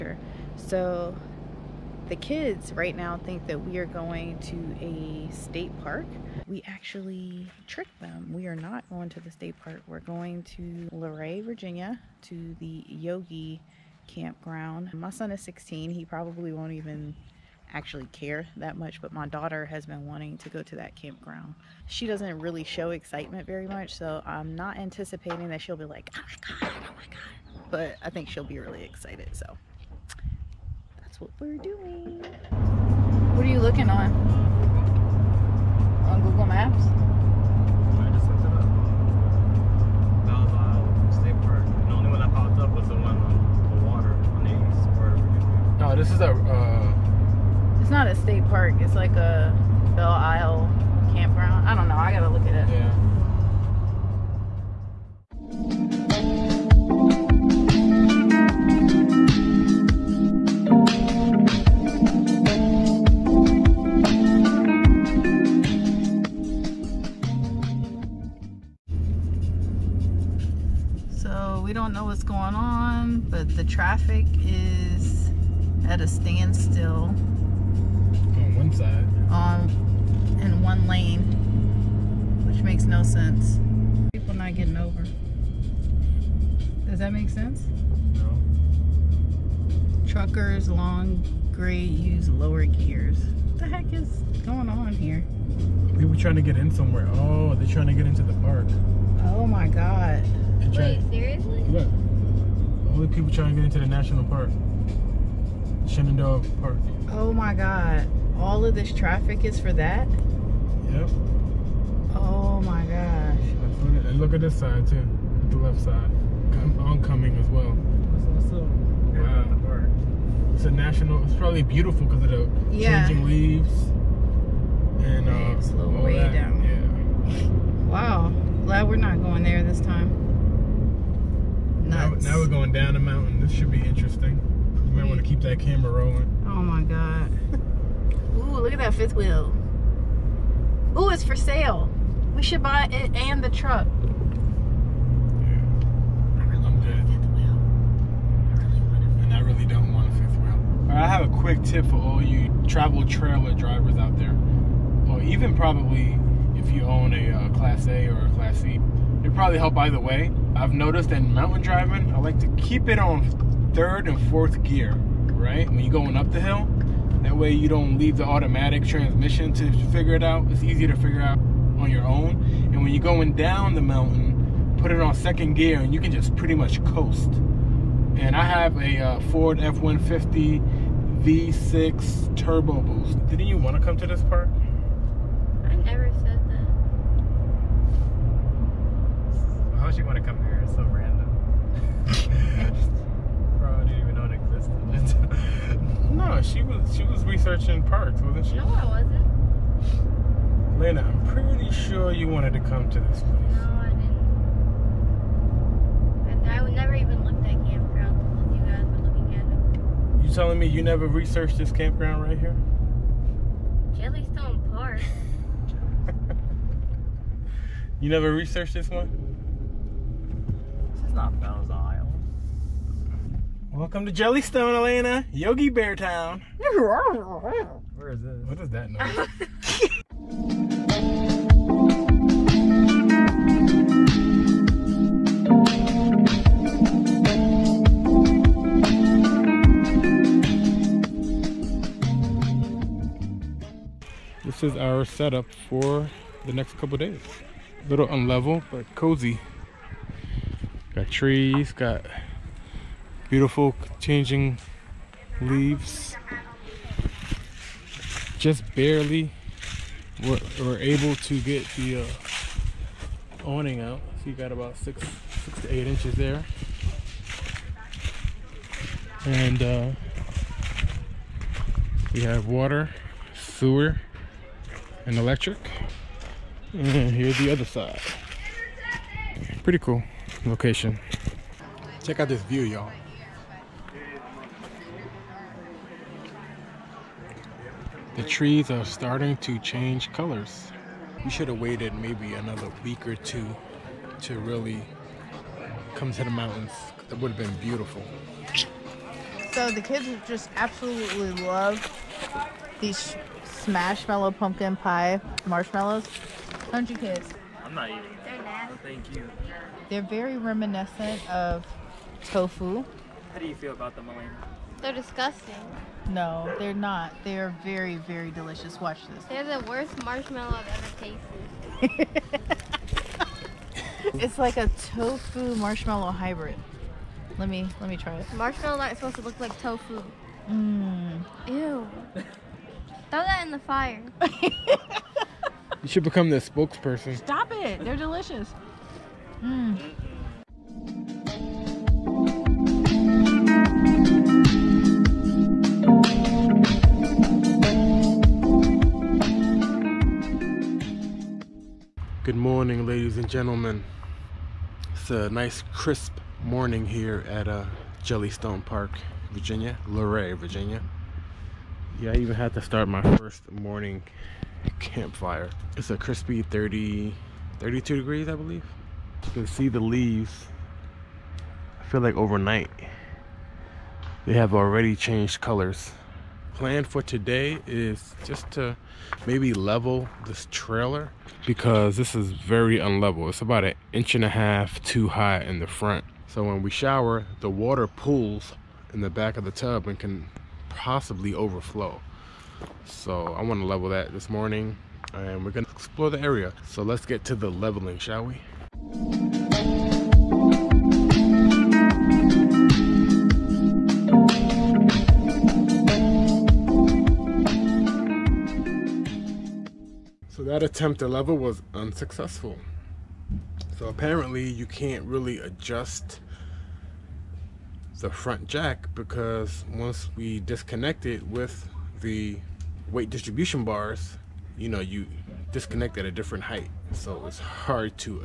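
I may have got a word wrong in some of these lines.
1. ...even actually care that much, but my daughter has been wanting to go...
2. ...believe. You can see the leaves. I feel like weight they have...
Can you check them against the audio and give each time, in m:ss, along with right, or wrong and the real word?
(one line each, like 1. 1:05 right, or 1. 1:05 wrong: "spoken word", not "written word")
1. 0:16 right
2. 6:08 wrong: "overnight", not "weight".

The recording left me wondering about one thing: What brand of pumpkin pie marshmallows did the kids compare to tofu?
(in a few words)
Smashmallow.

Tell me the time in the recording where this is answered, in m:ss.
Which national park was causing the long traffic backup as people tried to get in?
1:45.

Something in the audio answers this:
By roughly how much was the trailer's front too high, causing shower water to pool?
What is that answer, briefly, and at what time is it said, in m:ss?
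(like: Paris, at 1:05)
1.5 inches, at 6:23.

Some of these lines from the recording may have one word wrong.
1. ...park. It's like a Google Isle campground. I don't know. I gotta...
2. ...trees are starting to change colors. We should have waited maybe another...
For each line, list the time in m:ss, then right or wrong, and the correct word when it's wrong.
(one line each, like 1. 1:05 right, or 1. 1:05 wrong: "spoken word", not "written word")
1. 0:48 wrong: "Belle", not "Google"
2. 4:48 right.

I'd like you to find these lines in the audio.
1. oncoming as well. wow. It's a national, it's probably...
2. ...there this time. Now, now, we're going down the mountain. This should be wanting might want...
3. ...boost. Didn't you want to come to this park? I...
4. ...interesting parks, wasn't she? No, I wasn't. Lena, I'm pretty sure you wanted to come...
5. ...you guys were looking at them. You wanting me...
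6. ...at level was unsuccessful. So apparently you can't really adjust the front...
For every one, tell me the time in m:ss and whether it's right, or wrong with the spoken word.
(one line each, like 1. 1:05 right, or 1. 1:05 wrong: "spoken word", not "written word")
1. 1:56 right
2. 2:09 wrong: "interesting", not "wanting"
3. 3:02 right
4. 3:17 wrong: "researching", not "interesting"
5. 3:28 wrong: "telling", not "wanting"
6. 6:51 right.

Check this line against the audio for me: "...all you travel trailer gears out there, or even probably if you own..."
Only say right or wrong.
wrong.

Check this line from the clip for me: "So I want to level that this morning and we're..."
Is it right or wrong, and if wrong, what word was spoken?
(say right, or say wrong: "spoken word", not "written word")
right.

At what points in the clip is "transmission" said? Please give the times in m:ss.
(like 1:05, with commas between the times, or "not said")
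2:48.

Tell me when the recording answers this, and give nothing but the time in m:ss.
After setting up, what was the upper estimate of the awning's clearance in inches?
4:25.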